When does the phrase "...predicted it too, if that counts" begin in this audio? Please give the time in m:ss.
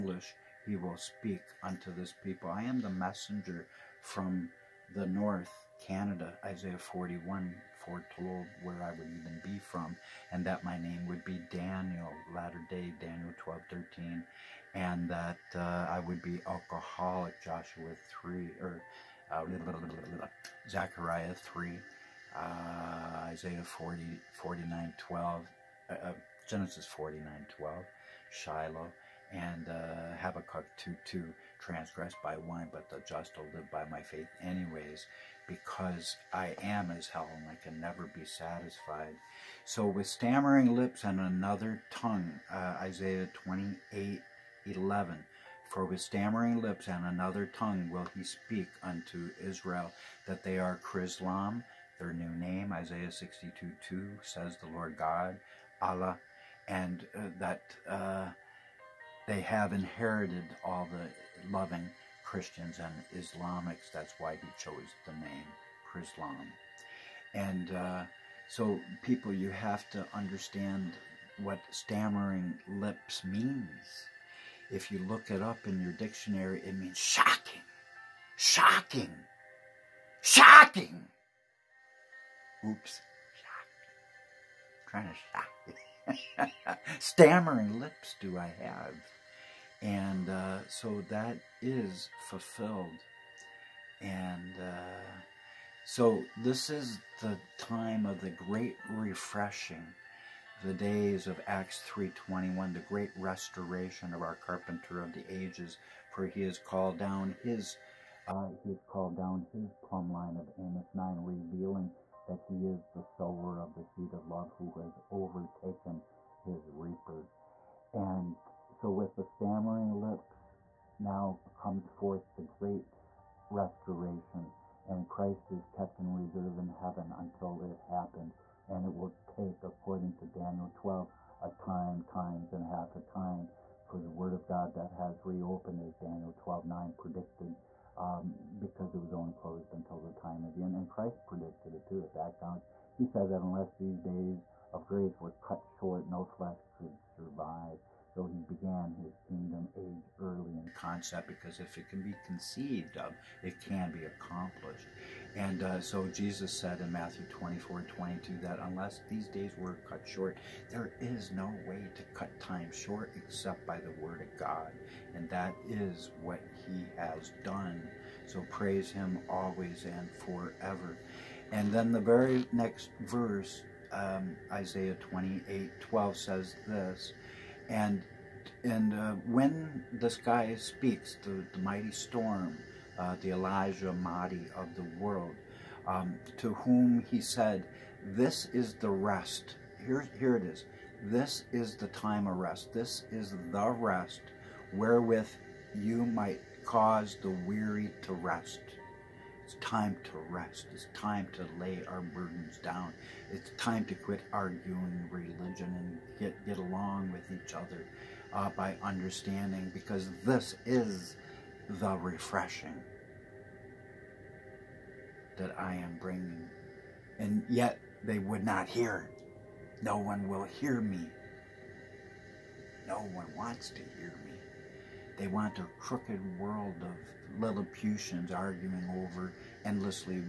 2:21.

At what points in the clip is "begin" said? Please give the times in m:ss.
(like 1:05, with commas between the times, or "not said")
not said.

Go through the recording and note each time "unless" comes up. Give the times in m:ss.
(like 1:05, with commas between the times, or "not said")
2:23, 2:38.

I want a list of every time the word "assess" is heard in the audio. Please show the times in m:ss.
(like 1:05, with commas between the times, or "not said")
not said.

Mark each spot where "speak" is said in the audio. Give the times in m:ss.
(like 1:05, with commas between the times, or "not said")
0:00, 0:48, 3:00.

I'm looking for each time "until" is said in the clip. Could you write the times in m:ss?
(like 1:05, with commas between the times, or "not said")
2:07, 2:19.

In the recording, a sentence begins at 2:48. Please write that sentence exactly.
So praise him always and forever.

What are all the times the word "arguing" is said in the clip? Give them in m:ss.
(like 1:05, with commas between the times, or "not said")
3:24, 3:48.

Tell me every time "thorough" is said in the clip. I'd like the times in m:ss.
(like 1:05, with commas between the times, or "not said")
not said.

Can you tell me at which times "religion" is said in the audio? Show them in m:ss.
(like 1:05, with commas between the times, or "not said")
3:25.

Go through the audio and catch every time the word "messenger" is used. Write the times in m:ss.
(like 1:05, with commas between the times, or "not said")
0:02.